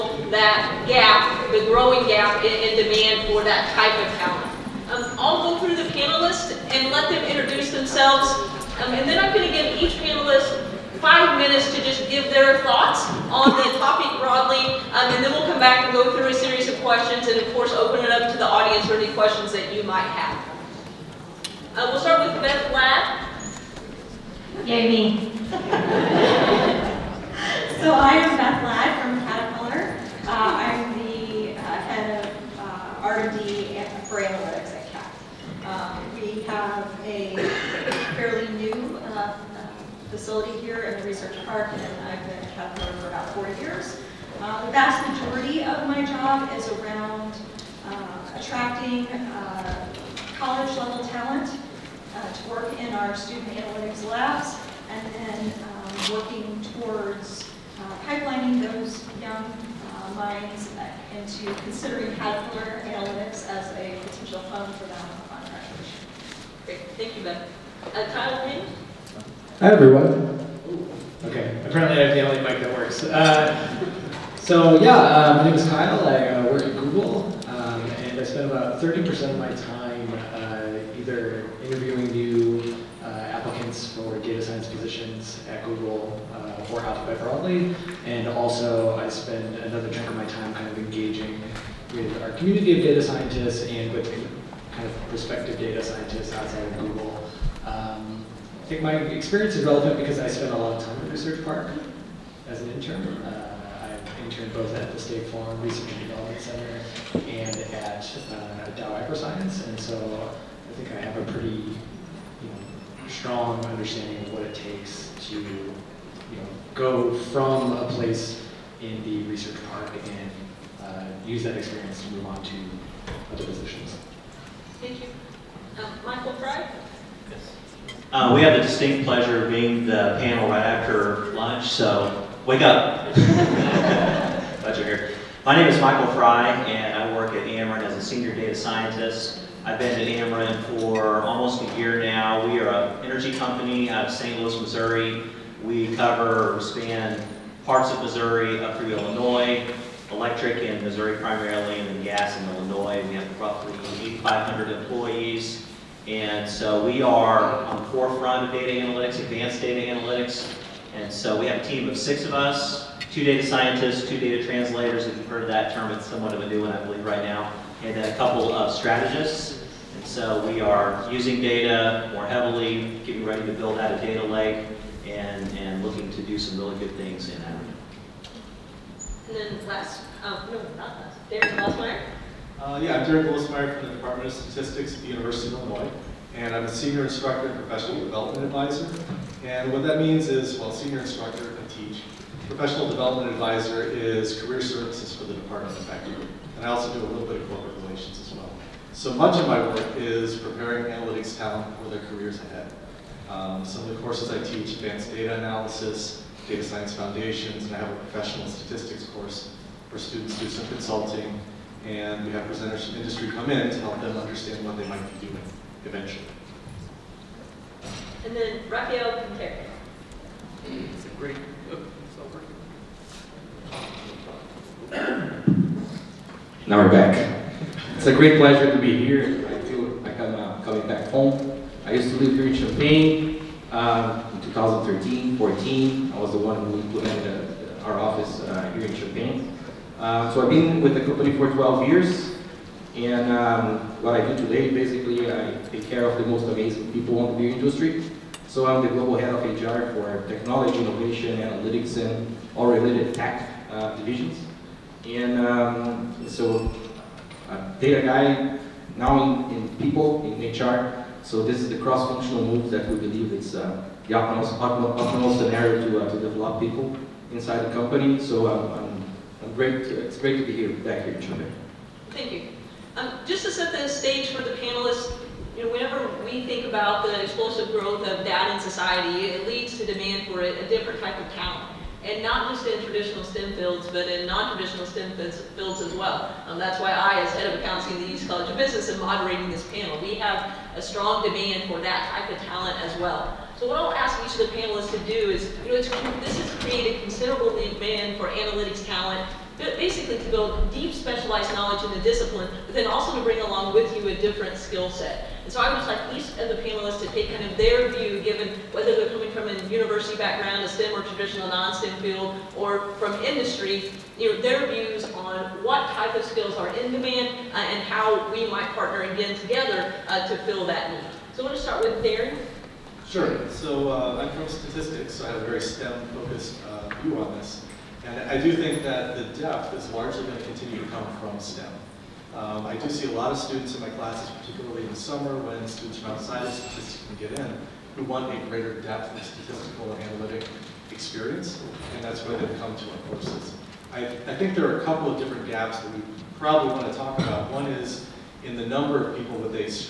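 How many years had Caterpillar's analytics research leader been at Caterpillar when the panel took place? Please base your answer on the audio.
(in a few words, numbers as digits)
4 years.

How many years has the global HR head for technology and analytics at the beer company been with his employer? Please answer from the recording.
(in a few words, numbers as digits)
12 years.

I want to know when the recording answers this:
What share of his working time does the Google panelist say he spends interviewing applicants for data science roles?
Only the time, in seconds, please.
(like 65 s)
78 s.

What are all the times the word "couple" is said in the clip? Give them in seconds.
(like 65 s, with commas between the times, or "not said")
168 s, 344 s.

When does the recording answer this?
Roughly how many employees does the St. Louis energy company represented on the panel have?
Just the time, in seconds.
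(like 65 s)
154 s.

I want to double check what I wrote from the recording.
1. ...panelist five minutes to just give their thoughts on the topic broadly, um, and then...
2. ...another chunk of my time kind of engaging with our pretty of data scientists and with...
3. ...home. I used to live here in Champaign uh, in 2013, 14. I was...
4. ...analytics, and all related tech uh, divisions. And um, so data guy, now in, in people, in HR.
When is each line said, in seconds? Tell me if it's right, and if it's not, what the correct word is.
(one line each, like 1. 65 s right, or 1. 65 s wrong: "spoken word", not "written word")
1. 9 s right
2. 89 s wrong: "community", not "pretty"
3. 231 s right
4. 251 s right.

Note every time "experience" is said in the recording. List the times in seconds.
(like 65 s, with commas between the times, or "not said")
98 s, 121 s, 340 s.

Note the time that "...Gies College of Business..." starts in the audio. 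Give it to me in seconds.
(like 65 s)
288 s.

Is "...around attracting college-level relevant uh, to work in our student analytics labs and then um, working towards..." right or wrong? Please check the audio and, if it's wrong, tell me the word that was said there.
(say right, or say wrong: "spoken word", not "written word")
wrong: "talent", not "relevant".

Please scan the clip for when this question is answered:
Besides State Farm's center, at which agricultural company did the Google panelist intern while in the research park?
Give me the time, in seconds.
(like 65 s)
108 s.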